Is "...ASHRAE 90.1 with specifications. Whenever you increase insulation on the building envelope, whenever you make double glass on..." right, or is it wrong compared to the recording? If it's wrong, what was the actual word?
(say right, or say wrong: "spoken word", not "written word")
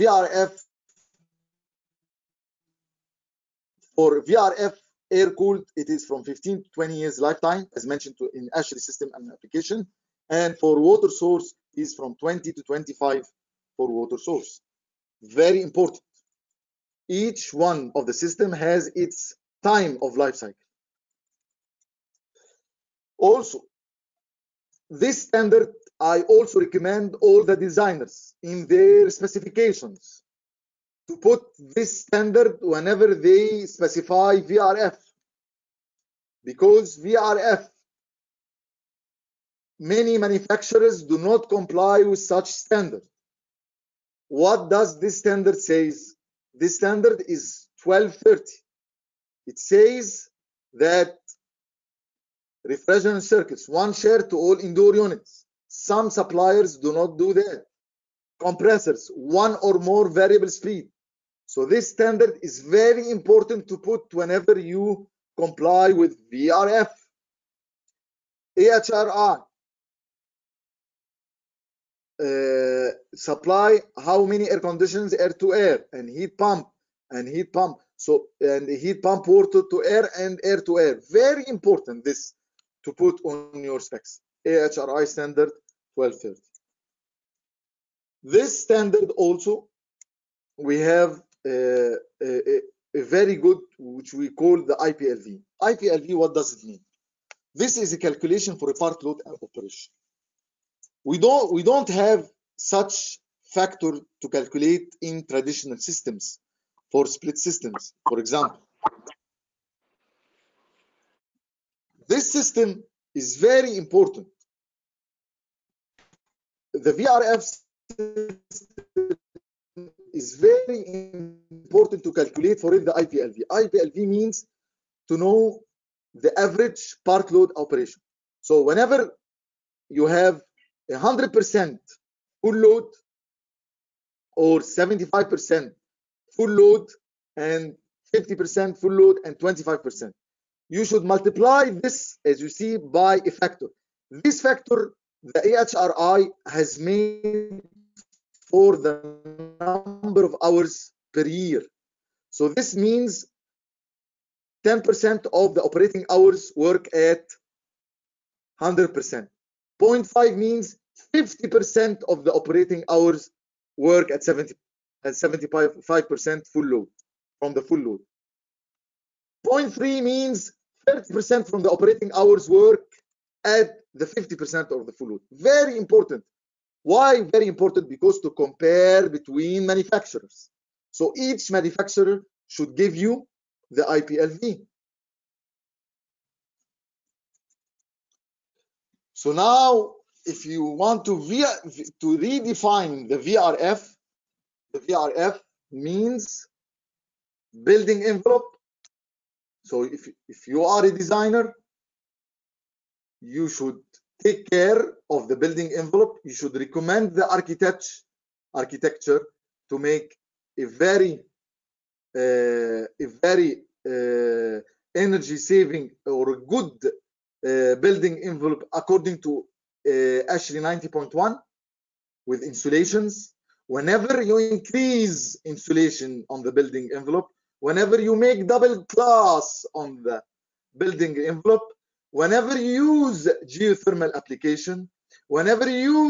wrong: "insulations", not "specifications".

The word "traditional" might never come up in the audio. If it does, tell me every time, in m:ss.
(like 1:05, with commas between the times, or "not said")
1:45.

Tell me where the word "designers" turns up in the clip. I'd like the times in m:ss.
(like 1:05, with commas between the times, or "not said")
0:27, 3:20.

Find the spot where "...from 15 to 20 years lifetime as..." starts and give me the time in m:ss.
0:06.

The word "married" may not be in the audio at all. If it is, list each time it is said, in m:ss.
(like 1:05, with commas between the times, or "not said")
not said.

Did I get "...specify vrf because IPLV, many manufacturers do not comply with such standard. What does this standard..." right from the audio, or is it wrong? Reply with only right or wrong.
wrong.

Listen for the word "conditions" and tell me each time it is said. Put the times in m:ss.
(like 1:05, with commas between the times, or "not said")
1:14.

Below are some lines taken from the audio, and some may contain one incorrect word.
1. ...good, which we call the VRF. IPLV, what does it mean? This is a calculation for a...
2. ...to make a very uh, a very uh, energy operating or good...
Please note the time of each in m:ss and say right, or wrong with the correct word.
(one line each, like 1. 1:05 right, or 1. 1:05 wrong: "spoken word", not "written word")
1. 1:33 wrong: "IPLV", not "VRF"
2. 3:29 wrong: "saving", not "operating".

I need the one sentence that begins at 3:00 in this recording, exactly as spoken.
So each manufacturer should give you the IPLV.